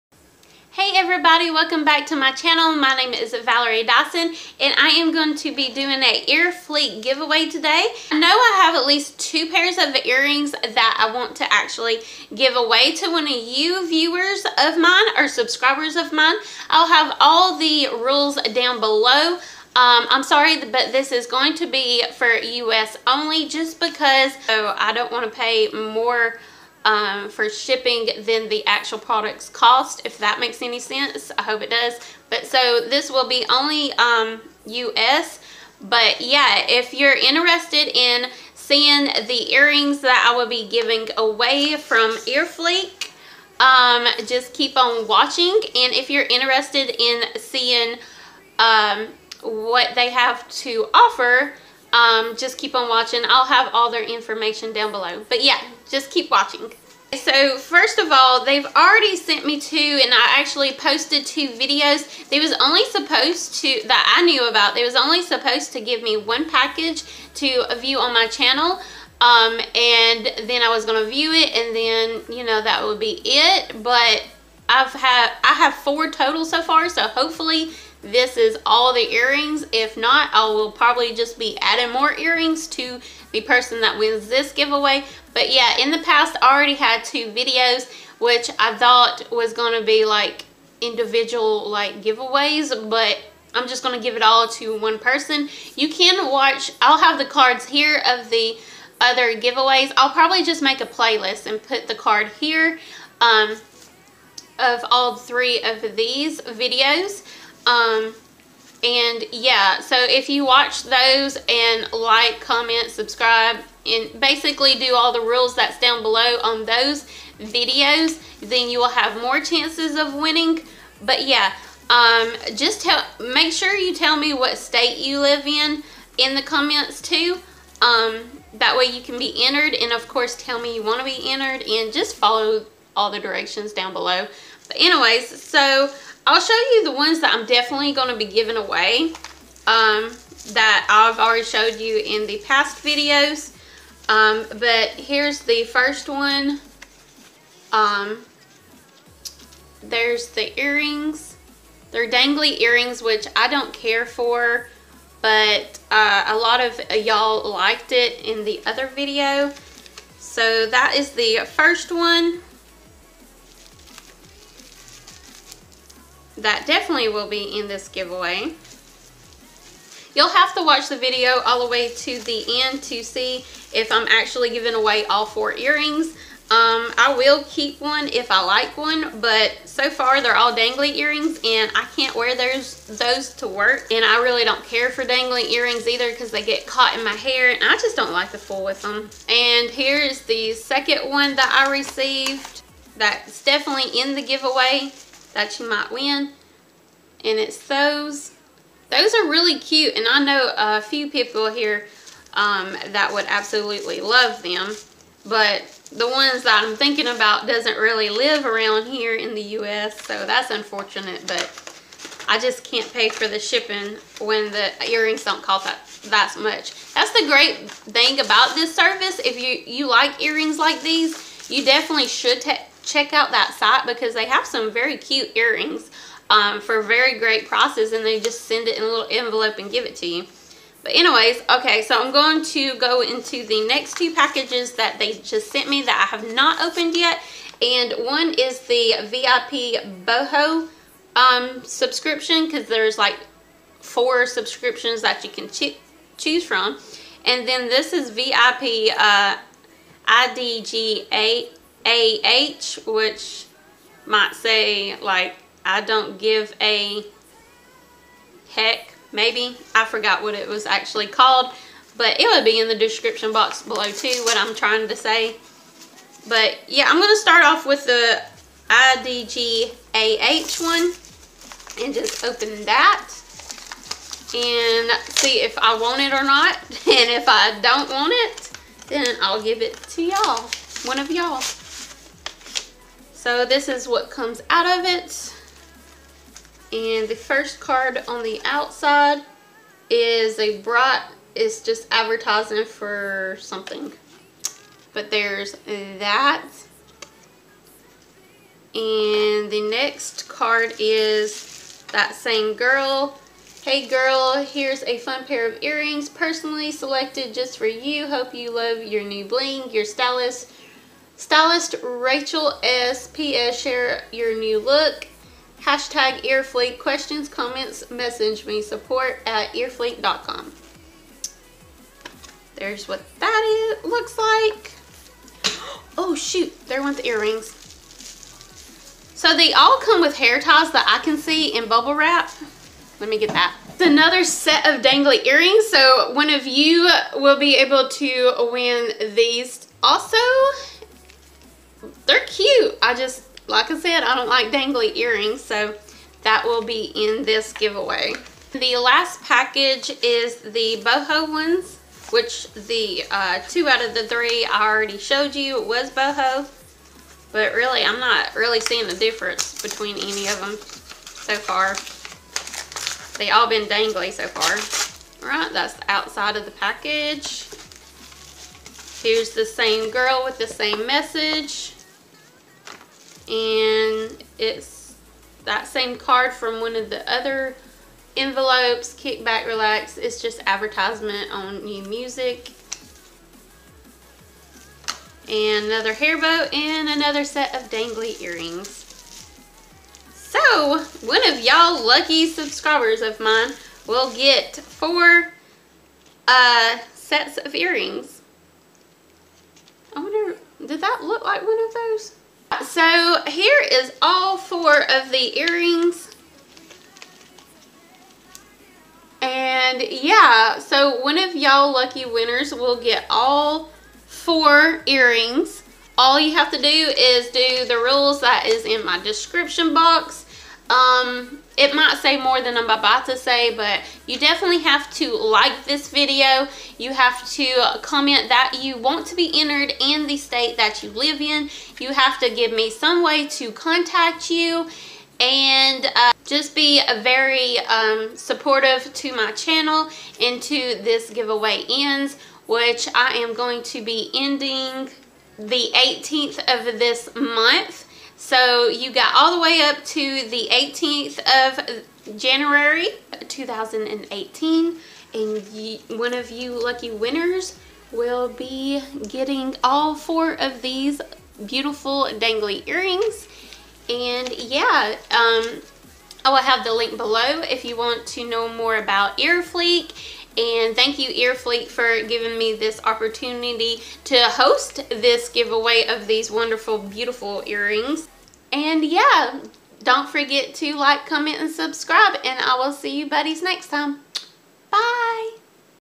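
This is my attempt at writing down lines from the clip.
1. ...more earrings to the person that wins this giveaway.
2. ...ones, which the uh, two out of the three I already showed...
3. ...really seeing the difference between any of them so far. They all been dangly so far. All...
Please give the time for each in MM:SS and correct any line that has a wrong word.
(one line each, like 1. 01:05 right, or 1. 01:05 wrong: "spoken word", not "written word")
1. 01:21 right
2. 05:51 right
3. 05:58 right.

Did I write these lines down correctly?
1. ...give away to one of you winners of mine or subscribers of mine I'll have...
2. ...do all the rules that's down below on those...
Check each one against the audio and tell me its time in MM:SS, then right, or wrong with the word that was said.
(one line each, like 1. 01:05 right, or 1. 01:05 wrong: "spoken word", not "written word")
1. 00:12 wrong: "viewers", not "winners"
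2. 01:54 right.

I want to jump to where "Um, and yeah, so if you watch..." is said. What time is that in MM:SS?
01:47.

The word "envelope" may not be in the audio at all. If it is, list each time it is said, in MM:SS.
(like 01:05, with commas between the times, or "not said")
03:49, 06:18.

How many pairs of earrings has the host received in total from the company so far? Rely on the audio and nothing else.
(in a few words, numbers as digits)
4.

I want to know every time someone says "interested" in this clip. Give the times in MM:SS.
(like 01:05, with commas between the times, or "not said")
00:37, 00:46.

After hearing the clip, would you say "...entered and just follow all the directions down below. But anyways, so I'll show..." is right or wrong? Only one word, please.
right.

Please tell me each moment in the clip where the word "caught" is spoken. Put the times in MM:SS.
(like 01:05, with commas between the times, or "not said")
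03:06.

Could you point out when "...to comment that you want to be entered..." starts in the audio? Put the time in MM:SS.
07:07.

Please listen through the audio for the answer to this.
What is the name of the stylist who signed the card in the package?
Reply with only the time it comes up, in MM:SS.
05:11.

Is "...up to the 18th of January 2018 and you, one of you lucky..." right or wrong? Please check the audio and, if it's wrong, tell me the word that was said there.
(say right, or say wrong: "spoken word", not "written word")
right.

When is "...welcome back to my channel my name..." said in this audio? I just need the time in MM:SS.
00:01.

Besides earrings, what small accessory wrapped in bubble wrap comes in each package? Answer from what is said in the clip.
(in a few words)
Hair ties.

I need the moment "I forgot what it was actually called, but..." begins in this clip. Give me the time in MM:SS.
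04:19.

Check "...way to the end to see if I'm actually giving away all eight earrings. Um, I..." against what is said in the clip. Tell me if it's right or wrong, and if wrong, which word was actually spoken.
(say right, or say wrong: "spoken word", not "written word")
wrong: "four", not "eight".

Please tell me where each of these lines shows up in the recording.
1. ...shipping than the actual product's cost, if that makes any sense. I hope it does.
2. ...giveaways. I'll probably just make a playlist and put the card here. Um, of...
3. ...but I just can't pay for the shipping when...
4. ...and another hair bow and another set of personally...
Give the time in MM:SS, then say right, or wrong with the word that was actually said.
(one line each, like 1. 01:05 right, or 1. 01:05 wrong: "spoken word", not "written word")
1. 00:27 right
2. 01:39 right
3. 03:31 right
4. 06:25 wrong: "dangly", not "personally".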